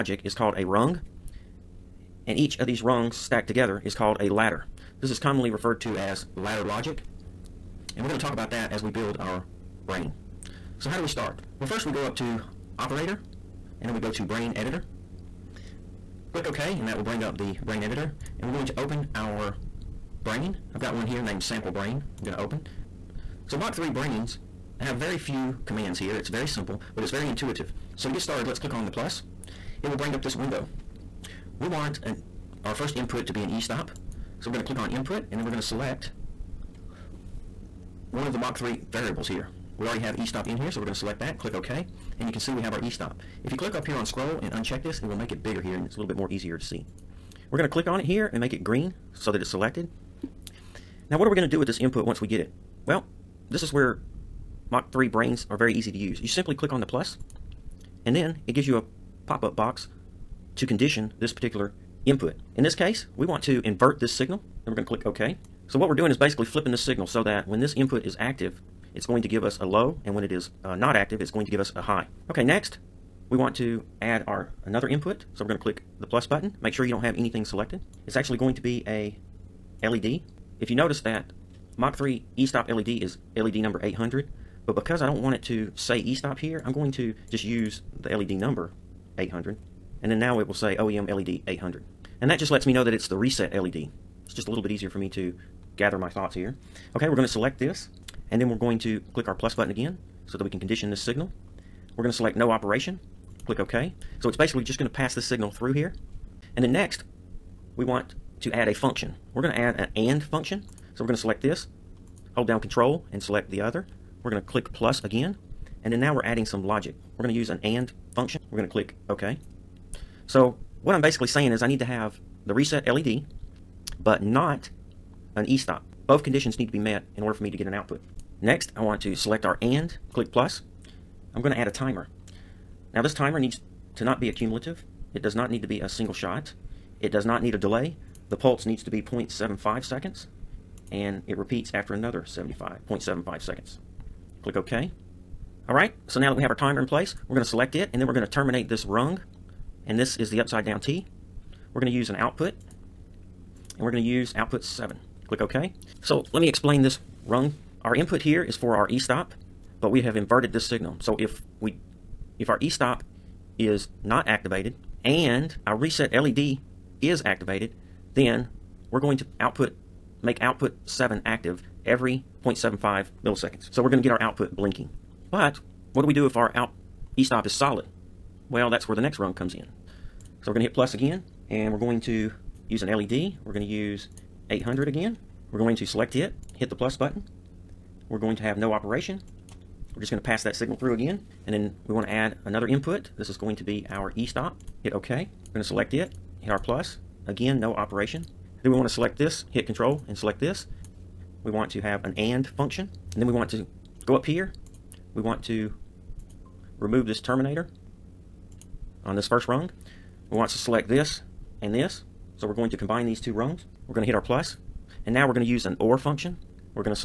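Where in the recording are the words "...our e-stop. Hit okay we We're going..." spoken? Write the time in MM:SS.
03:13.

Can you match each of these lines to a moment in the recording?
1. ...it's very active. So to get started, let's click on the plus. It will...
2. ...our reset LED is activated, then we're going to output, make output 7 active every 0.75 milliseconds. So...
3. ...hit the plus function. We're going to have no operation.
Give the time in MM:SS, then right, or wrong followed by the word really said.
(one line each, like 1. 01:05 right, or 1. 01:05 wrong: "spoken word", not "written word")
1. 00:27 wrong: "intuitive", not "active"
2. 02:45 right
3. 03:06 wrong: "button", not "function".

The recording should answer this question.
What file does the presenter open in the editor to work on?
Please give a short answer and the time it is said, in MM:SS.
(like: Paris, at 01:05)
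sample brain, at 00:21.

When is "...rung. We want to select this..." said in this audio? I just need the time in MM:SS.
03:29.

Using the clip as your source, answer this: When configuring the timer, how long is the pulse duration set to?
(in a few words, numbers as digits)
0.75 seconds.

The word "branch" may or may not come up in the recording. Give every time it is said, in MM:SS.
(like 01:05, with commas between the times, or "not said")
not said.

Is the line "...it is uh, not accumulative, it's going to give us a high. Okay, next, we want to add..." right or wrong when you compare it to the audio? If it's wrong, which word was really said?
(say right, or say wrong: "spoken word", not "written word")
wrong: "active", not "accumulative".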